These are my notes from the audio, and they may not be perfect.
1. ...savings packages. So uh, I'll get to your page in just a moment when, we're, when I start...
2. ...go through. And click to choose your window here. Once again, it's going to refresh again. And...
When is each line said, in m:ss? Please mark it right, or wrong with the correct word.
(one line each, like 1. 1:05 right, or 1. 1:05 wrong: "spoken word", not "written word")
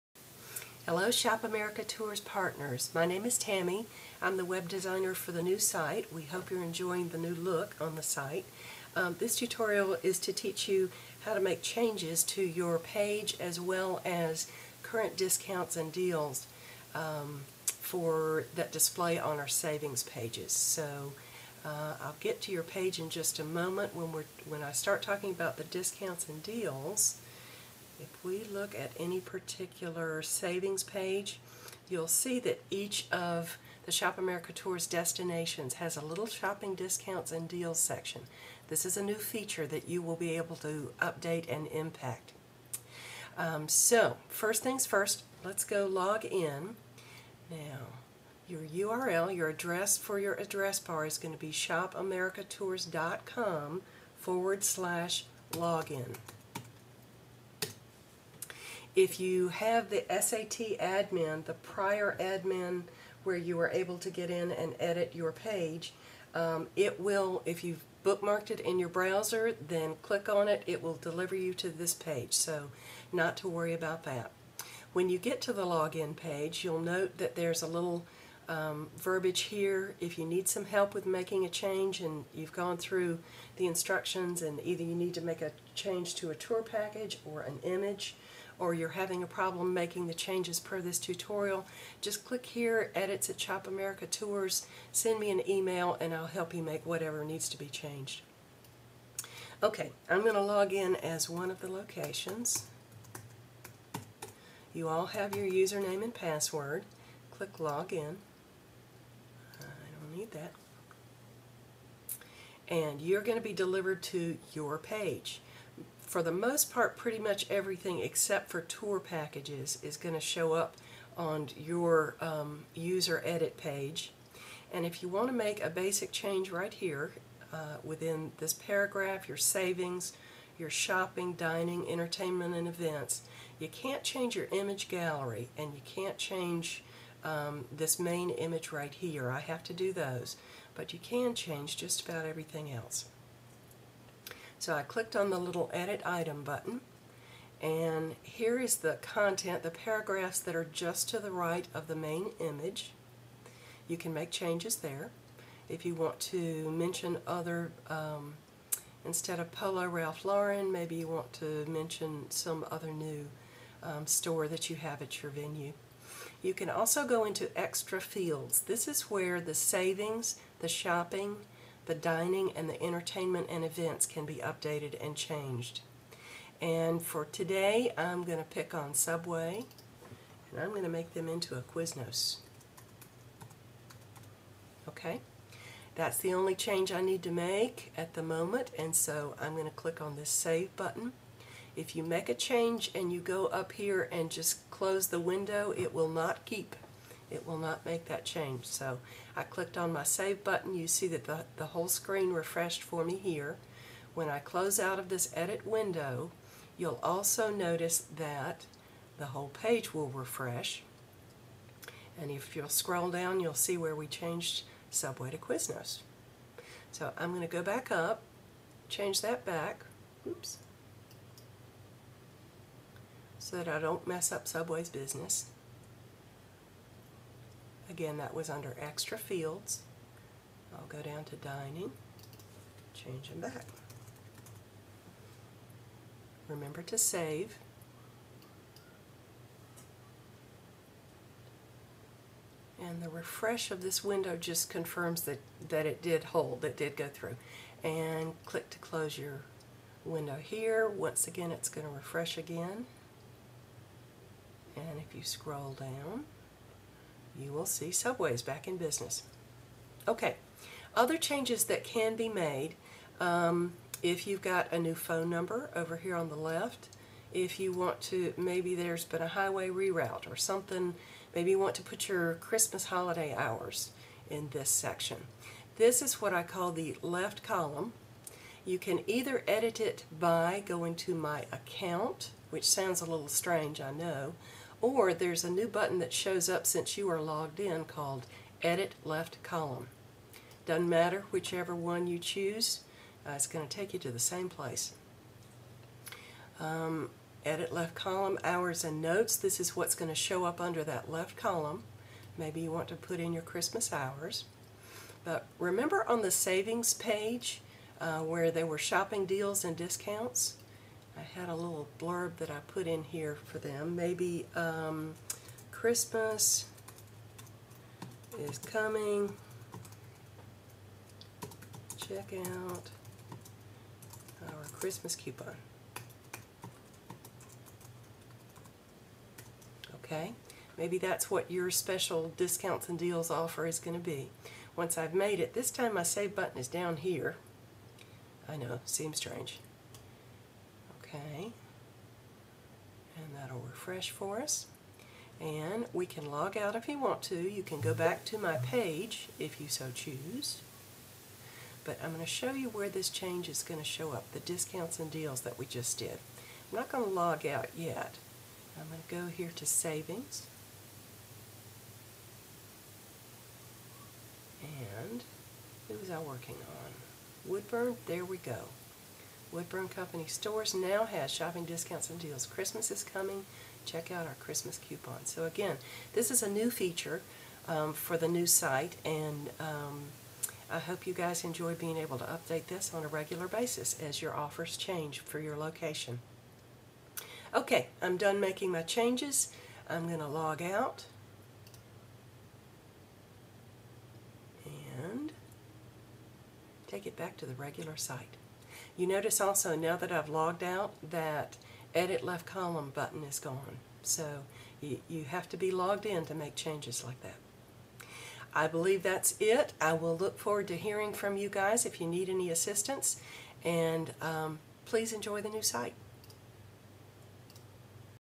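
1. 0:19 wrong: "pages", not "packages"
2. 4:06 wrong: "close", not "choose".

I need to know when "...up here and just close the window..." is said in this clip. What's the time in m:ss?
3:13.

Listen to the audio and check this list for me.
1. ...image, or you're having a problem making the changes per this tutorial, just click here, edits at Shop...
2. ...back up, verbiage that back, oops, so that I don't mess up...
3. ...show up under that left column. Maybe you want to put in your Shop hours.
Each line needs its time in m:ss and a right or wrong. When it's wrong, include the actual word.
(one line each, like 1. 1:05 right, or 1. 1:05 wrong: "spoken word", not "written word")
1. 1:27 right
2. 3:37 wrong: "change", not "verbiage"
3. 5:00 wrong: "Christmas", not "Shop".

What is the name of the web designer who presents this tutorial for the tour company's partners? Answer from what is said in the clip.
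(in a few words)
Tammy.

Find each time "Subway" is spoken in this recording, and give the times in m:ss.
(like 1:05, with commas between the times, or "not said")
2:58, 3:34, 3:44, 4:17.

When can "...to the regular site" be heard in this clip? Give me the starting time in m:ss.
6:37.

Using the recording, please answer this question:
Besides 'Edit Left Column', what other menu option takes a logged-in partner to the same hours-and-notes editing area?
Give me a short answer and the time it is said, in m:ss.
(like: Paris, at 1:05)
My account, at 4:41.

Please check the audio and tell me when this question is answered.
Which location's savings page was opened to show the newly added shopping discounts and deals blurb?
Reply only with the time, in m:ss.
6:09.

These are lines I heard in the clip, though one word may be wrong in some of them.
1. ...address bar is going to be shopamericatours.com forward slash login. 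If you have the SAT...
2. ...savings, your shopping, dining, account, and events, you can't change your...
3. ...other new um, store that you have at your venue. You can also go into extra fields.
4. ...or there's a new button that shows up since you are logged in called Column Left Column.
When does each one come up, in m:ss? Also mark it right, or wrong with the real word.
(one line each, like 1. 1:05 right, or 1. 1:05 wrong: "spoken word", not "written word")
1. 0:50 right
2. 2:09 wrong: "entertainment", not "account"
3. 2:42 right
4. 4:44 wrong: "Edit", not "Column".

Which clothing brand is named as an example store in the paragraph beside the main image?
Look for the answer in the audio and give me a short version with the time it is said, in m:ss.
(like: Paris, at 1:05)
Polo Ralph Lauren, at 2:39.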